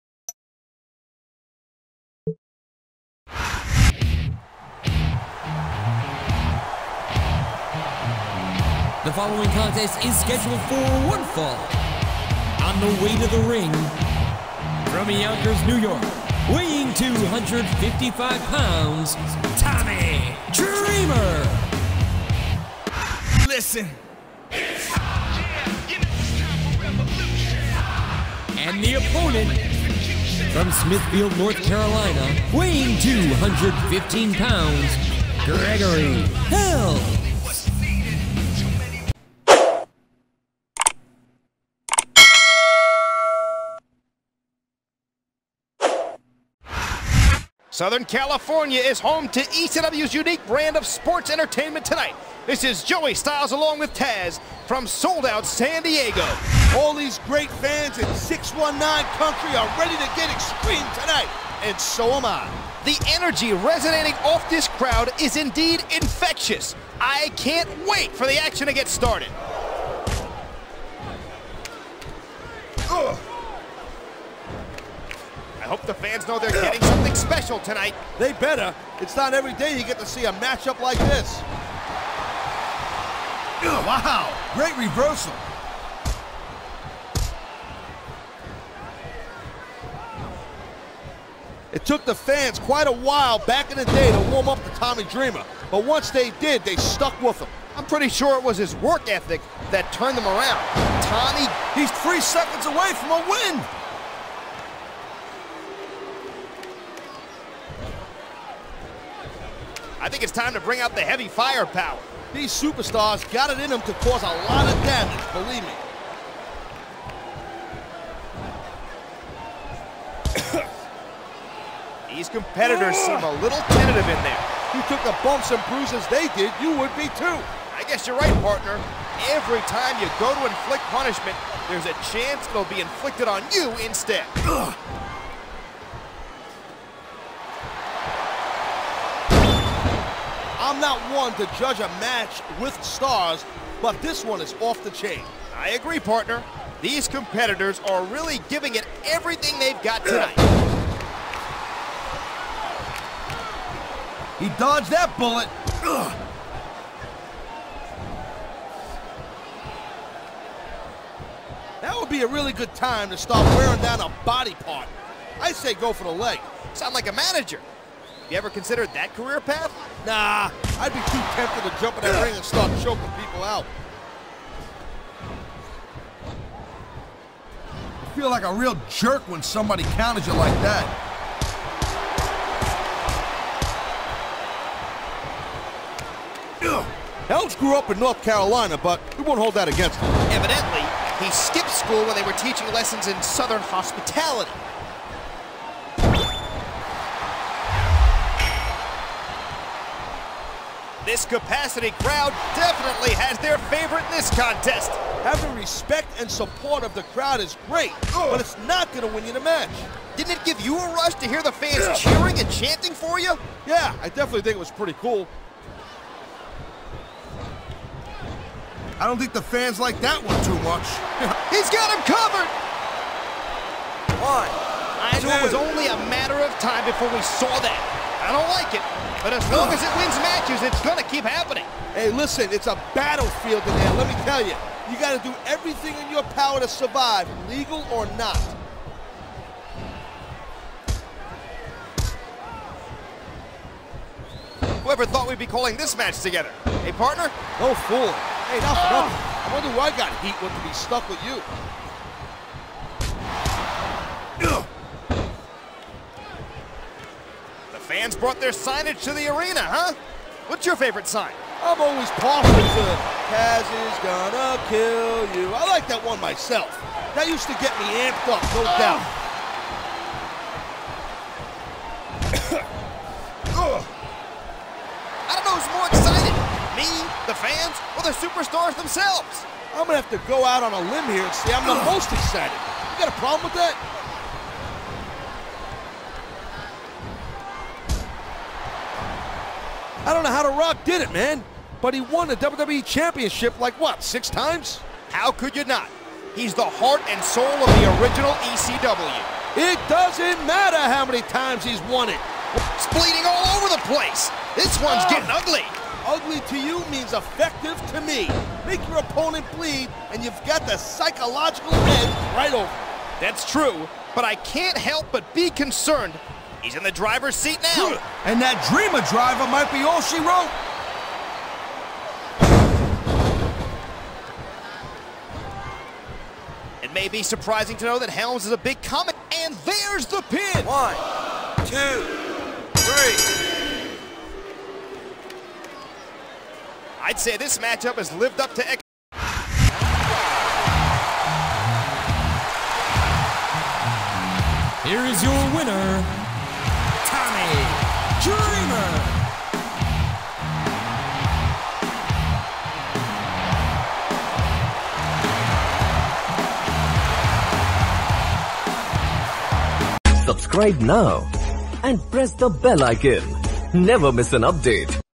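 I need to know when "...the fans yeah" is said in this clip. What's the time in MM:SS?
03:31.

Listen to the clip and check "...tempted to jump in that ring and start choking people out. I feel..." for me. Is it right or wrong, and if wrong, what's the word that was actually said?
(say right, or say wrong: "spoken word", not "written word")
right.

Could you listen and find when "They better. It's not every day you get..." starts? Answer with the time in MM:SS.
01:18.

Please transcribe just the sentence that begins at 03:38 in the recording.
I don't think the fans like that one too much.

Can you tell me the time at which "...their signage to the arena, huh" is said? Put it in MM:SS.
04:18.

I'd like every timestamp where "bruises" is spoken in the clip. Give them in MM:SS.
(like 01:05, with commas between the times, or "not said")
02:05.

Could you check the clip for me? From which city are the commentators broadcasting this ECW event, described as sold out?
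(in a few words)
San Diego.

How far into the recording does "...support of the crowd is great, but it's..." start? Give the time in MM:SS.
03:26.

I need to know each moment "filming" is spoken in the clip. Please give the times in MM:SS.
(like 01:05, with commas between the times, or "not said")
not said.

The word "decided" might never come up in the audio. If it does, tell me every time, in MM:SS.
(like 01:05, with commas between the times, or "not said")
not said.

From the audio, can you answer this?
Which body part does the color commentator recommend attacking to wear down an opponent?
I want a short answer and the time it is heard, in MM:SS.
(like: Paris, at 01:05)
The leg, at 02:46.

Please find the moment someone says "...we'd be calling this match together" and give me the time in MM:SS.
04:05.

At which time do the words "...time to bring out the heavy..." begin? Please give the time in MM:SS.
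01:50.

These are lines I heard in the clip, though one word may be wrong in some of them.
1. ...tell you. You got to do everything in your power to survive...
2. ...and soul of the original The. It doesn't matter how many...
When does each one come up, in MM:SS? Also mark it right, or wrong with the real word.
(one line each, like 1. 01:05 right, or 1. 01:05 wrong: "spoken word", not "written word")
1. 03:54 right
2. 04:57 wrong: "ECW", not "The".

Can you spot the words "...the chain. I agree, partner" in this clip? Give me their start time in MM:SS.
02:24.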